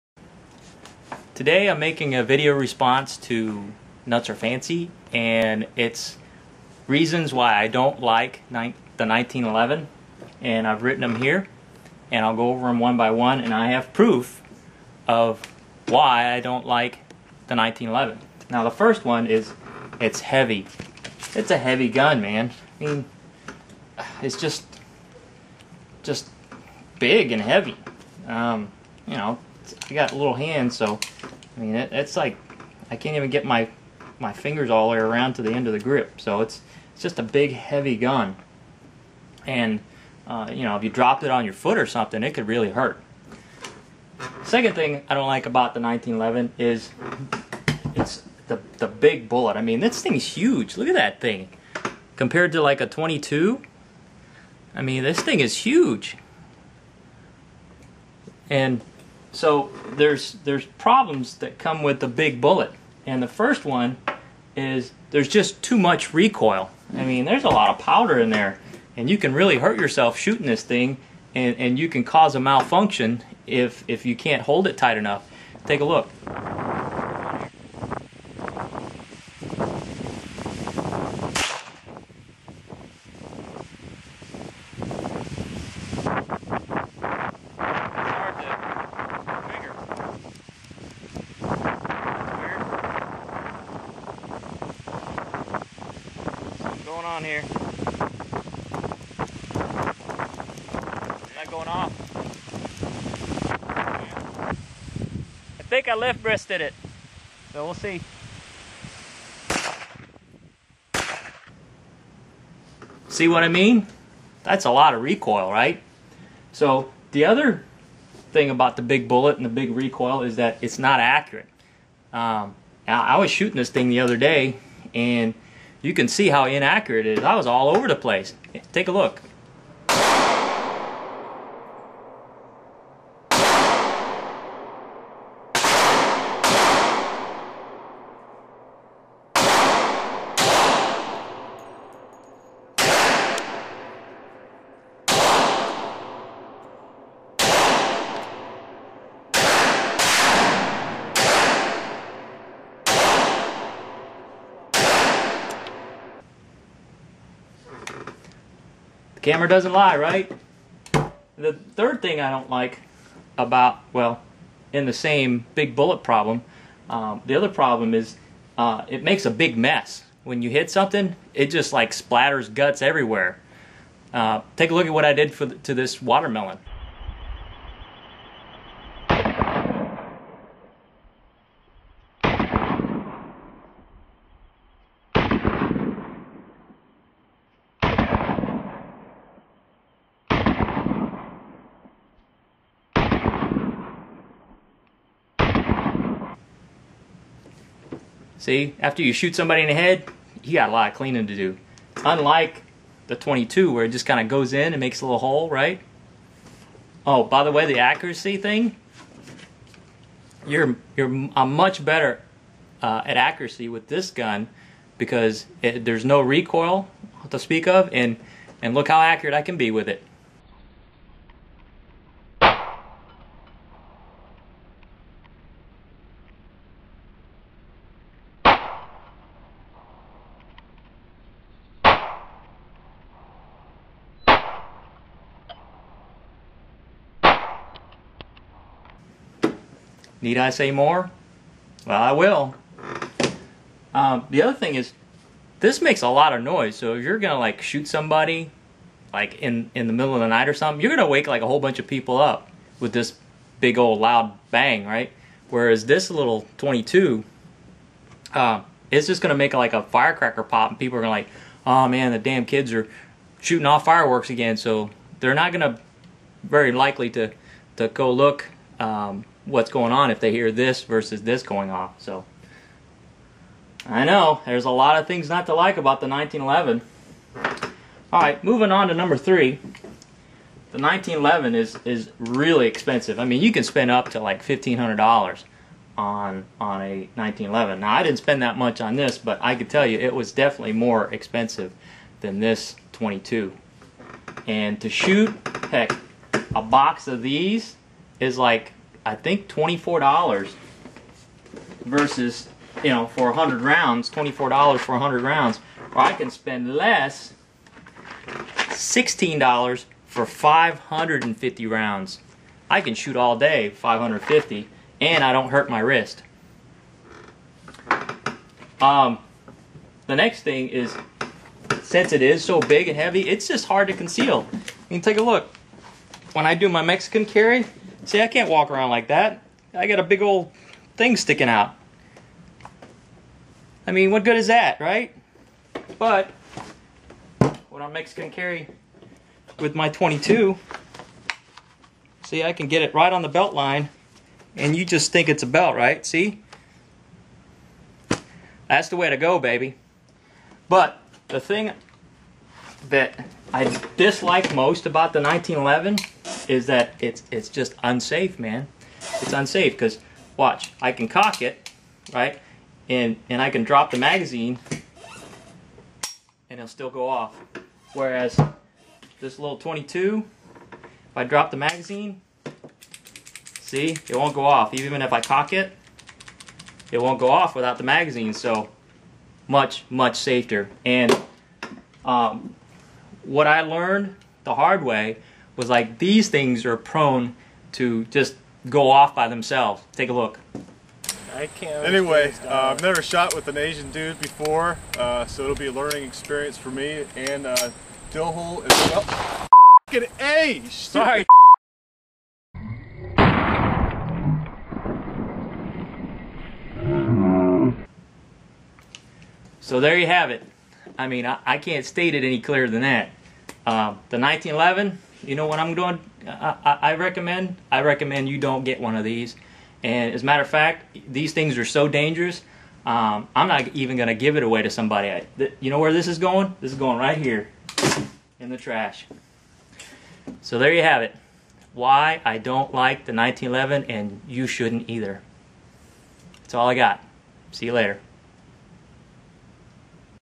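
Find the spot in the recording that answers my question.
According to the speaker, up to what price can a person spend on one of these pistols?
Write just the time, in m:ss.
4:44.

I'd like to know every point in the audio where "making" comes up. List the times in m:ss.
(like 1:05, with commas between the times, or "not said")
0:01.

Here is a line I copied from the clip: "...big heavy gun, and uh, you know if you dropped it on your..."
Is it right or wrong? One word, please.
right.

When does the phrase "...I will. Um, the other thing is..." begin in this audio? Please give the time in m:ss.
4:02.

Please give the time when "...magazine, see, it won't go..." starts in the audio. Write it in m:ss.
6:11.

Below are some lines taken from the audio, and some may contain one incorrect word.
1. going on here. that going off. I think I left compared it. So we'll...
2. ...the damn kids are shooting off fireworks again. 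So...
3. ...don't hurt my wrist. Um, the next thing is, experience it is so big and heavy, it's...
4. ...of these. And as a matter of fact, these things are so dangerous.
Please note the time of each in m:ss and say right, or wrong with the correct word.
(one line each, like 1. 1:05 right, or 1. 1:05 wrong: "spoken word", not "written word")
1. 1:37 wrong: "breasted", not "compared"
2. 4:22 right
3. 5:15 wrong: "since", not "experience"
4. 6:58 right.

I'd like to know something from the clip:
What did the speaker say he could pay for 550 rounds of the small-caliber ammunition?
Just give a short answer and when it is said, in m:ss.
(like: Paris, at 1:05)
$16, at 5:08.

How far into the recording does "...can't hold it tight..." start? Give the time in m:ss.
1:14.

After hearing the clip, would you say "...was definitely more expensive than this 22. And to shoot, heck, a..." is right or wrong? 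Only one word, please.
right.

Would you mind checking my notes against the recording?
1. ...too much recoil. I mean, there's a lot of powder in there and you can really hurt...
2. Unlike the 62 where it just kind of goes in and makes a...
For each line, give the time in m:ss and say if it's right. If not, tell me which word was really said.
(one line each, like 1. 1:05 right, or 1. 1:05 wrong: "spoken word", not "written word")
1. 1:05 right
2. 3:22 wrong: "22", not "62".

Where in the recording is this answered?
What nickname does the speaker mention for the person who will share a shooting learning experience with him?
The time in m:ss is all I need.
6:38.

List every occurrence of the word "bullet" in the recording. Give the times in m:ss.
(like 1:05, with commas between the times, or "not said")
0:49, 1:02, 1:59, 2:45.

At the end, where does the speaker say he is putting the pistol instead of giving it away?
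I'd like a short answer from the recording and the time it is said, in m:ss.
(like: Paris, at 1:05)
the trash, at 7:08.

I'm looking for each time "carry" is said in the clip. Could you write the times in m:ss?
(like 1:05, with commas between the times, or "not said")
5:27, 5:38.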